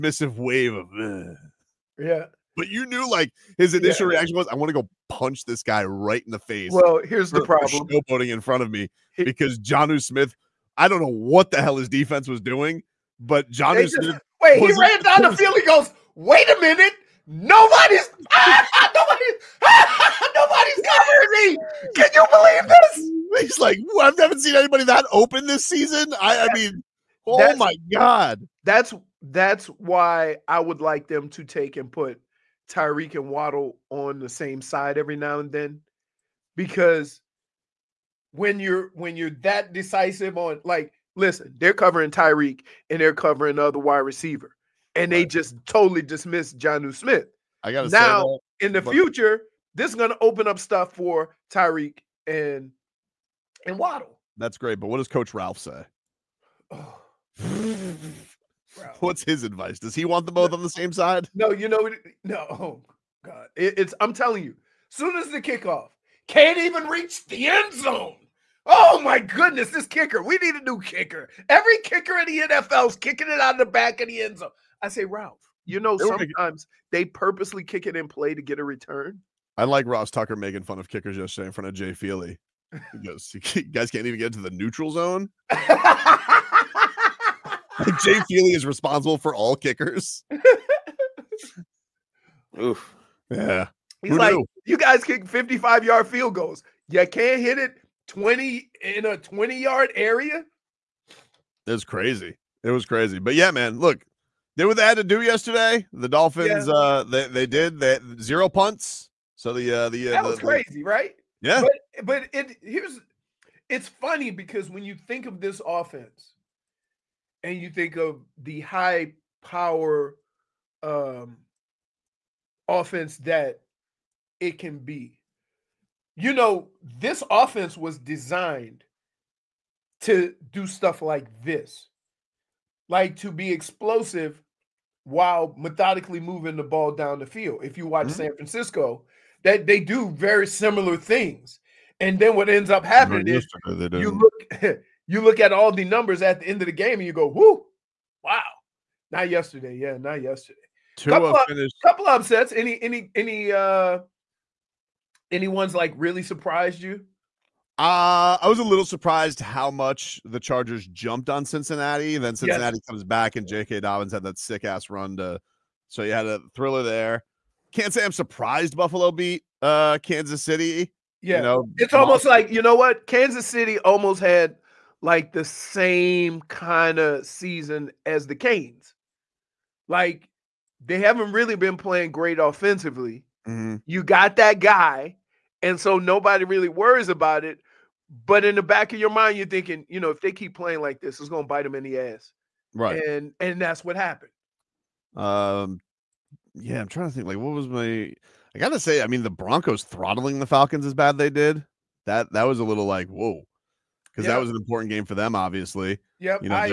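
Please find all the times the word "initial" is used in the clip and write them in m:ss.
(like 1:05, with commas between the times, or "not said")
0:03.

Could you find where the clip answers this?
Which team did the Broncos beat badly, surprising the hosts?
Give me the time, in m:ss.
3:20.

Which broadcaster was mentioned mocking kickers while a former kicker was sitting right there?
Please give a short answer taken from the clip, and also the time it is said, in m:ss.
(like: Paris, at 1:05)
Ross Tucker, at 1:19.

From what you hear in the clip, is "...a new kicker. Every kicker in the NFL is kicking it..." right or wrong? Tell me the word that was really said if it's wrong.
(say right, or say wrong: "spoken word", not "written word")
right.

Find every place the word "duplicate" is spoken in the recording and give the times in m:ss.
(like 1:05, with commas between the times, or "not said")
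not said.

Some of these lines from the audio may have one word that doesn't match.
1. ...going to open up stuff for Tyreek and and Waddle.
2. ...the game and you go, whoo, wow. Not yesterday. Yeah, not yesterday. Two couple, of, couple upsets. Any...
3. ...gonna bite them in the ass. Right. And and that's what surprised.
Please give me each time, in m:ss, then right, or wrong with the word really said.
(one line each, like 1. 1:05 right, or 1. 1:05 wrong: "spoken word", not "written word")
1. 0:49 right
2. 2:26 right
3. 3:11 wrong: "happened", not "surprised".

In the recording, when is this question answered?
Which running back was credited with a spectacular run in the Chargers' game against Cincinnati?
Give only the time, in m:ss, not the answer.
2:43.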